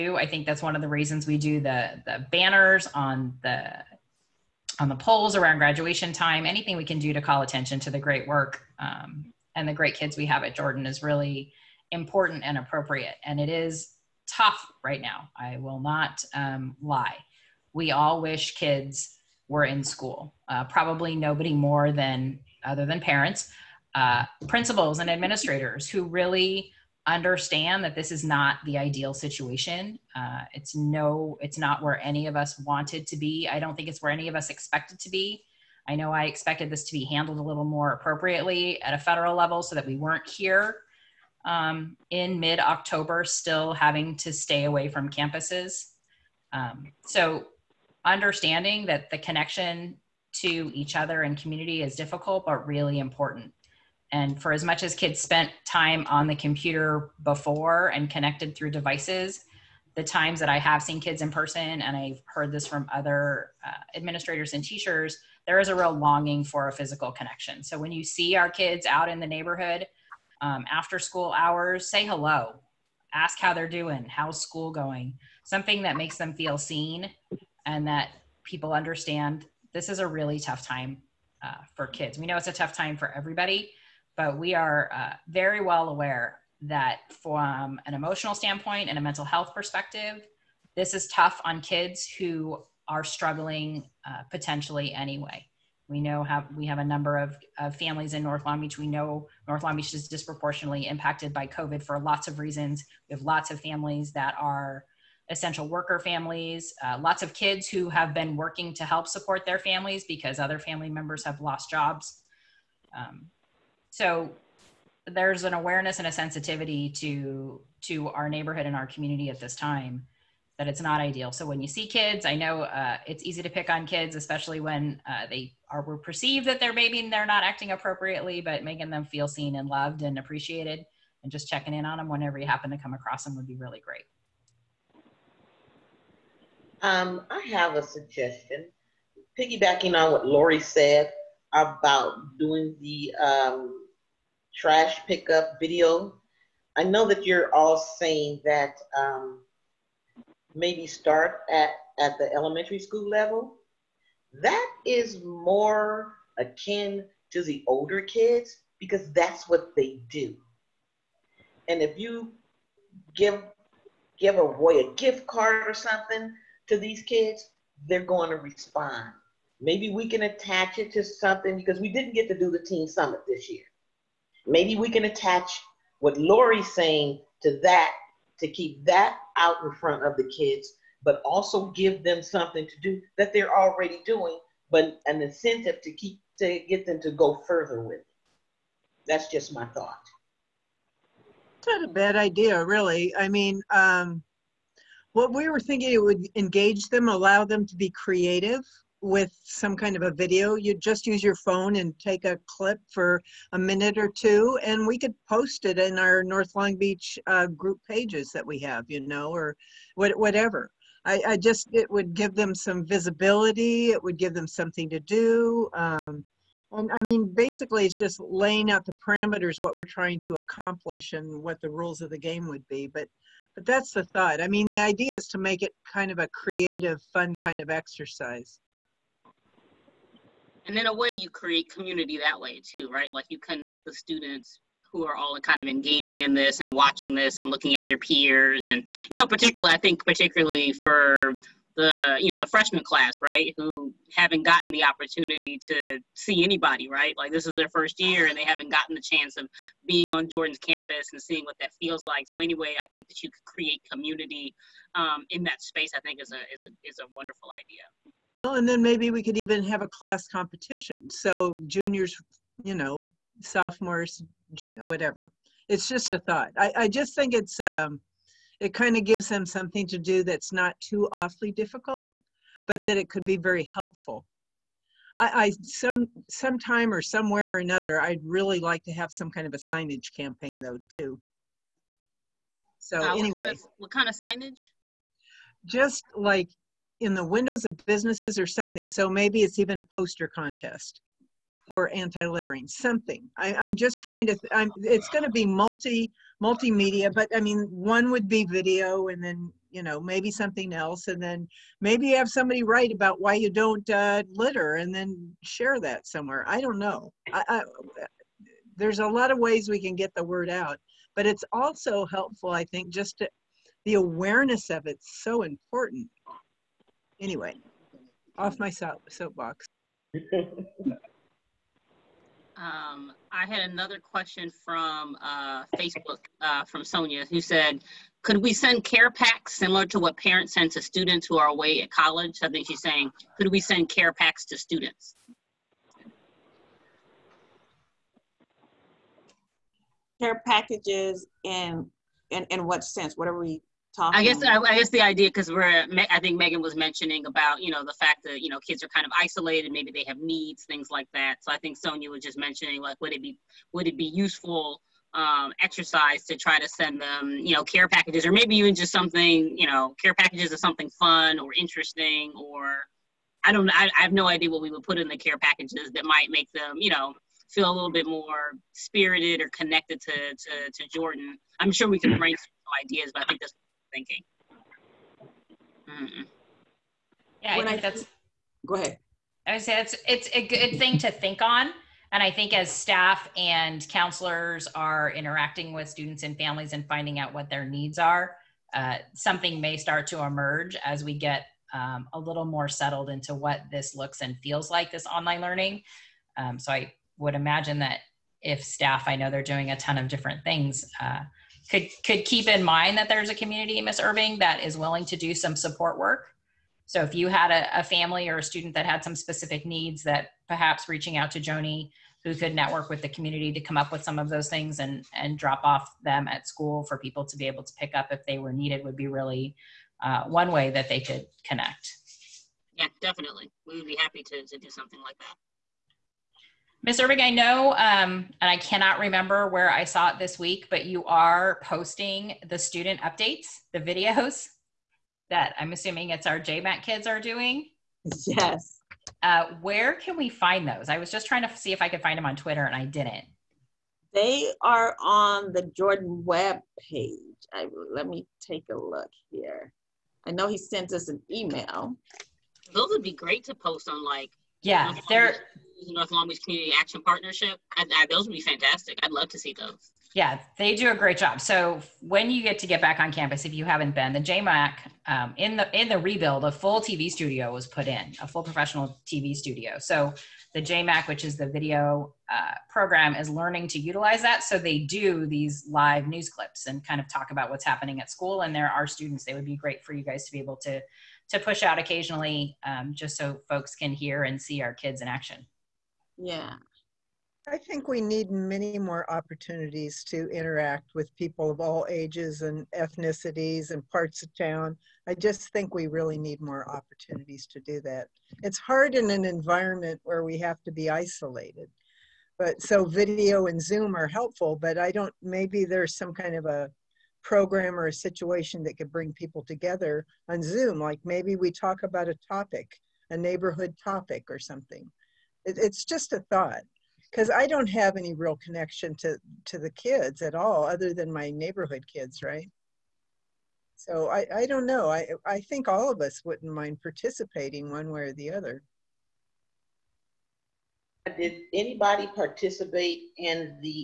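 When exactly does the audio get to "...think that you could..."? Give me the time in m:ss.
4:12.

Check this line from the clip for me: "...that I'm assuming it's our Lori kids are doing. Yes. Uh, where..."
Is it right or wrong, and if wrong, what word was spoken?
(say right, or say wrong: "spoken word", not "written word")
wrong: "JMAC", not "Lori".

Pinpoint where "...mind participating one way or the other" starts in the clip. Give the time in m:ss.
8:46.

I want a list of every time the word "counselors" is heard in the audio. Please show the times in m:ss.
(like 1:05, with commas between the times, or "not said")
6:23.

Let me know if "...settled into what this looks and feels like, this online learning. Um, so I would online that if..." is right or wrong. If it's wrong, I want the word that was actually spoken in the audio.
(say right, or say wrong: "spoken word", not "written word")
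wrong: "imagine", not "online".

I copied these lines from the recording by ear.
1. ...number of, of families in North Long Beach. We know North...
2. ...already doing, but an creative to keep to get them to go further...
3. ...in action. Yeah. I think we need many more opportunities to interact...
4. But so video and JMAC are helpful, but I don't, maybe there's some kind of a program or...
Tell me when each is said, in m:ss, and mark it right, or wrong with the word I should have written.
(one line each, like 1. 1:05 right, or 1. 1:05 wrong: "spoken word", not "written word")
1. 1:36 right
2. 3:03 wrong: "incentive", not "creative"
3. 8:05 right
4. 8:22 wrong: "Zoom", not "JMAC".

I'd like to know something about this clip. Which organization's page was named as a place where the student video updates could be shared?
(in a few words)
North Long Beach Community Action Partnership.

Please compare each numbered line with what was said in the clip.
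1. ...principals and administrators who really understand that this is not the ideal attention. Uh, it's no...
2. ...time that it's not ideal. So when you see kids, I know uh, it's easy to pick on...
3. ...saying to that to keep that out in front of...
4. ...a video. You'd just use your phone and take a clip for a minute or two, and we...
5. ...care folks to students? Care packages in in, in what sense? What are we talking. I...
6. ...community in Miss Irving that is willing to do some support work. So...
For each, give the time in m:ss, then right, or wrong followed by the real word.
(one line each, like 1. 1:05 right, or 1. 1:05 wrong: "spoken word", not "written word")
1. 0:24 wrong: "situation", not "attention"
2. 1:59 right
3. 2:56 right
4. 3:20 right
5. 5:33 wrong: "packs", not "folks"
6. 6:43 right.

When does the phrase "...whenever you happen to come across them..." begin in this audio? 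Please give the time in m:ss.
2:12.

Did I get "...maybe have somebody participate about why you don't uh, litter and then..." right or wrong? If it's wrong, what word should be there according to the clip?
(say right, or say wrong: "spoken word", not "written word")
wrong: "write", not "participate".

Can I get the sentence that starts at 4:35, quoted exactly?
I, I some sometime or somewhere or another, I'd really like to have some kind of a signage campaign though too.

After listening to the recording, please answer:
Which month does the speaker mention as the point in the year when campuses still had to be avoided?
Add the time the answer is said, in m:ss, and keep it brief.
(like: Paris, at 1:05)
October, at 0:42.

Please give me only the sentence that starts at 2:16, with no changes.
Um, I have a suggestion, piggybacking on what Lori said about doing the um, trash pickup video.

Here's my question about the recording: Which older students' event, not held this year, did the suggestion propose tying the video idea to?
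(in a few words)
teen summit.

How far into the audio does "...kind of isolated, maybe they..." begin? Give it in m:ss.
5:48.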